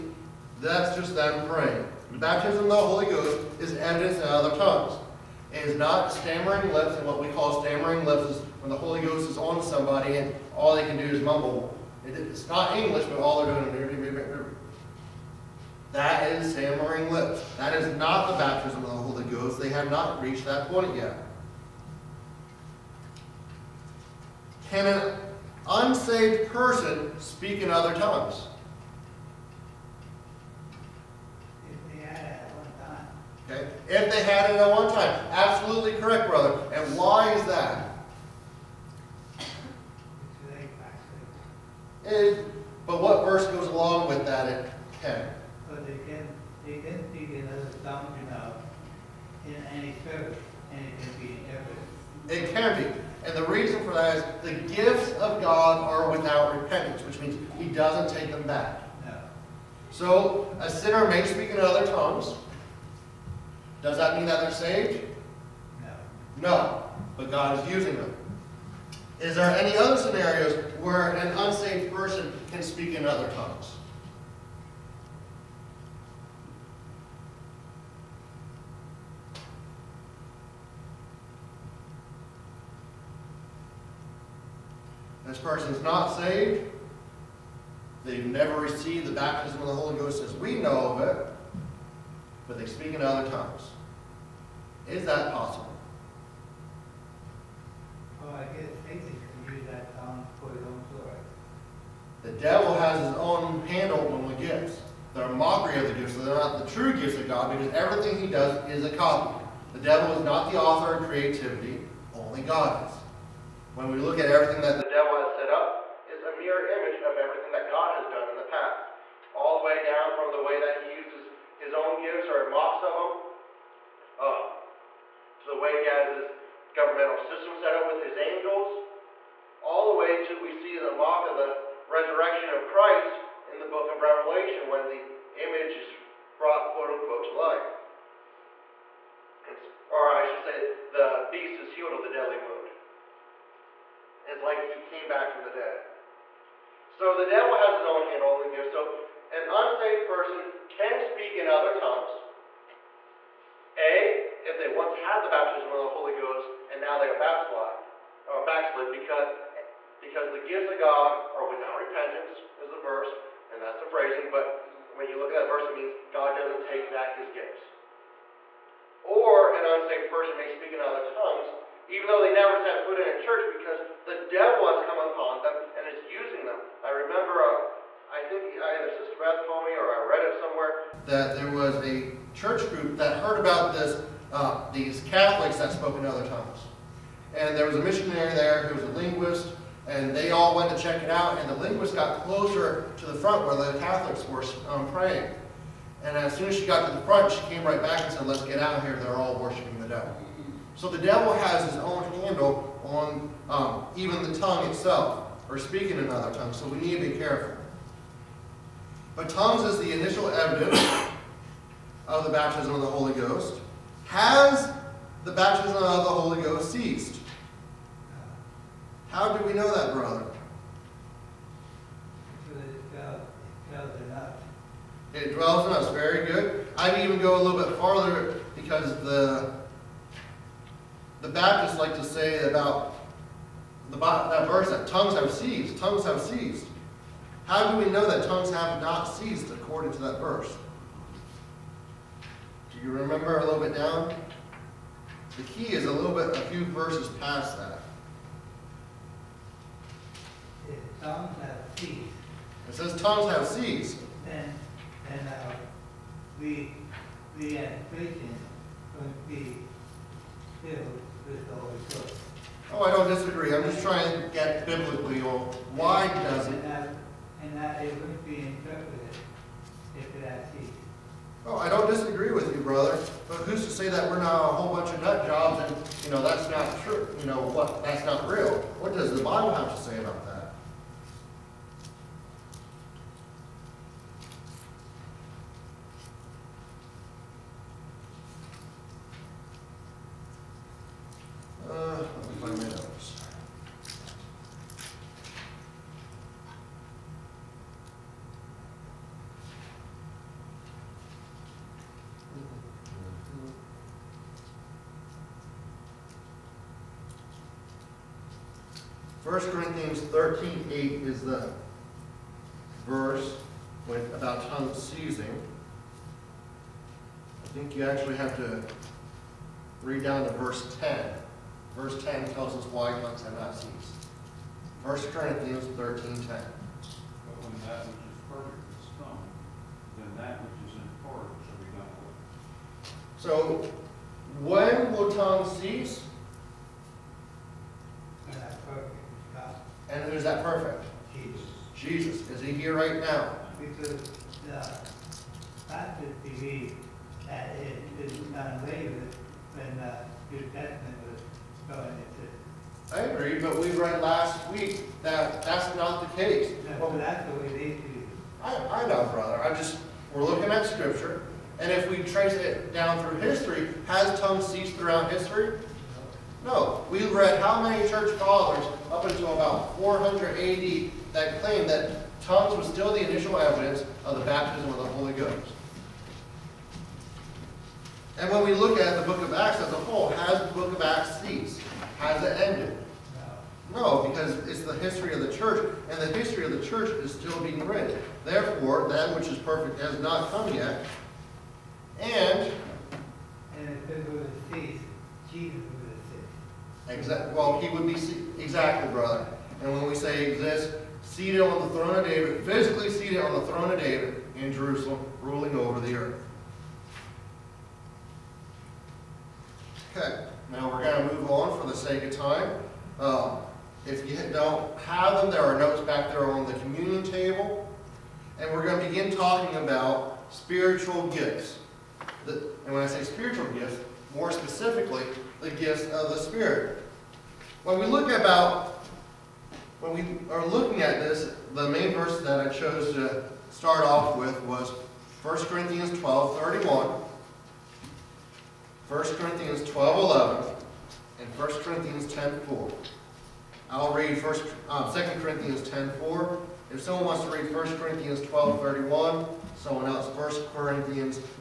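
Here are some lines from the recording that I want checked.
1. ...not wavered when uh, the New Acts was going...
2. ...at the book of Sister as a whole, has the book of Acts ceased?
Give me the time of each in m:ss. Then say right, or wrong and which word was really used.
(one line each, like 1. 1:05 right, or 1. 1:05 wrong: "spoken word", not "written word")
1. 5:48 wrong: "Testament", not "Acts"
2. 6:18 wrong: "Acts", not "Sister".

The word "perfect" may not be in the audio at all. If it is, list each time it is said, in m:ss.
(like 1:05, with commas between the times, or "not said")
5:40, 6:29.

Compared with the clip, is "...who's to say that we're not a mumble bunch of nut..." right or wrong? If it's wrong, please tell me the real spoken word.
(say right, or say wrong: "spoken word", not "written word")
wrong: "whole", not "mumble".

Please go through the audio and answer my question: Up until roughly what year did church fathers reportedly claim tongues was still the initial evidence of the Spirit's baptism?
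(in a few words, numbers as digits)
400 AD.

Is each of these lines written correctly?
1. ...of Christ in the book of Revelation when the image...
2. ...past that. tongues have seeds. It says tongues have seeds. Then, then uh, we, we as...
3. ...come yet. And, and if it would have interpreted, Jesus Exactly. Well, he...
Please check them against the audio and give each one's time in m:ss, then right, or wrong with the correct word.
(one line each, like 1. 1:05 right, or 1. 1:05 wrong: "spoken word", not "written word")
1. 2:12 right
2. 4:07 right
3. 6:30 wrong: "ceased", not "interpreted".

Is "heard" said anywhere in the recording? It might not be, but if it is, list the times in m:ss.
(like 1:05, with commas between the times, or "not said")
3:03.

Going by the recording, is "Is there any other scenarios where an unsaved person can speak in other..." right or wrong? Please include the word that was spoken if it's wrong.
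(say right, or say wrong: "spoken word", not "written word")
right.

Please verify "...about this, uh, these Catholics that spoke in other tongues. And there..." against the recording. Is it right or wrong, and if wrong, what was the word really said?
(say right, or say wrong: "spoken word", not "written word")
right.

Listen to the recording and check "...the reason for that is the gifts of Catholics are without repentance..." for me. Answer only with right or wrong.
wrong.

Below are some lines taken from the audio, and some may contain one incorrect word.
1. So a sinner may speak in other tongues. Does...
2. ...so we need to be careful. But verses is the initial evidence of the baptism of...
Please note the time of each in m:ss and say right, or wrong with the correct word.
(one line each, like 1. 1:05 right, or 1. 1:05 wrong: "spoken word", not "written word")
1. 0:59 right
2. 3:26 wrong: "tongues", not "verses".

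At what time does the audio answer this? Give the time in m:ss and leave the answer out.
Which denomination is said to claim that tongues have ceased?
3:51.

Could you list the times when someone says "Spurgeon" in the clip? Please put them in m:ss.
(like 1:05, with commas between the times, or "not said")
not said.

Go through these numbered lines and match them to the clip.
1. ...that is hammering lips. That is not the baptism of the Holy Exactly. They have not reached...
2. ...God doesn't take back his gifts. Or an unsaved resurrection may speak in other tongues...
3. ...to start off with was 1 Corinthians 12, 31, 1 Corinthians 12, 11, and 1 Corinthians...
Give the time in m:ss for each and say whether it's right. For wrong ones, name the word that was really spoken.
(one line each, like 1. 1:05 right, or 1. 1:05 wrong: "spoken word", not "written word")
1. 0:15 wrong: "Ghost", not "Exactly"
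2. 2:46 wrong: "person", not "resurrection"
3. 7:12 right.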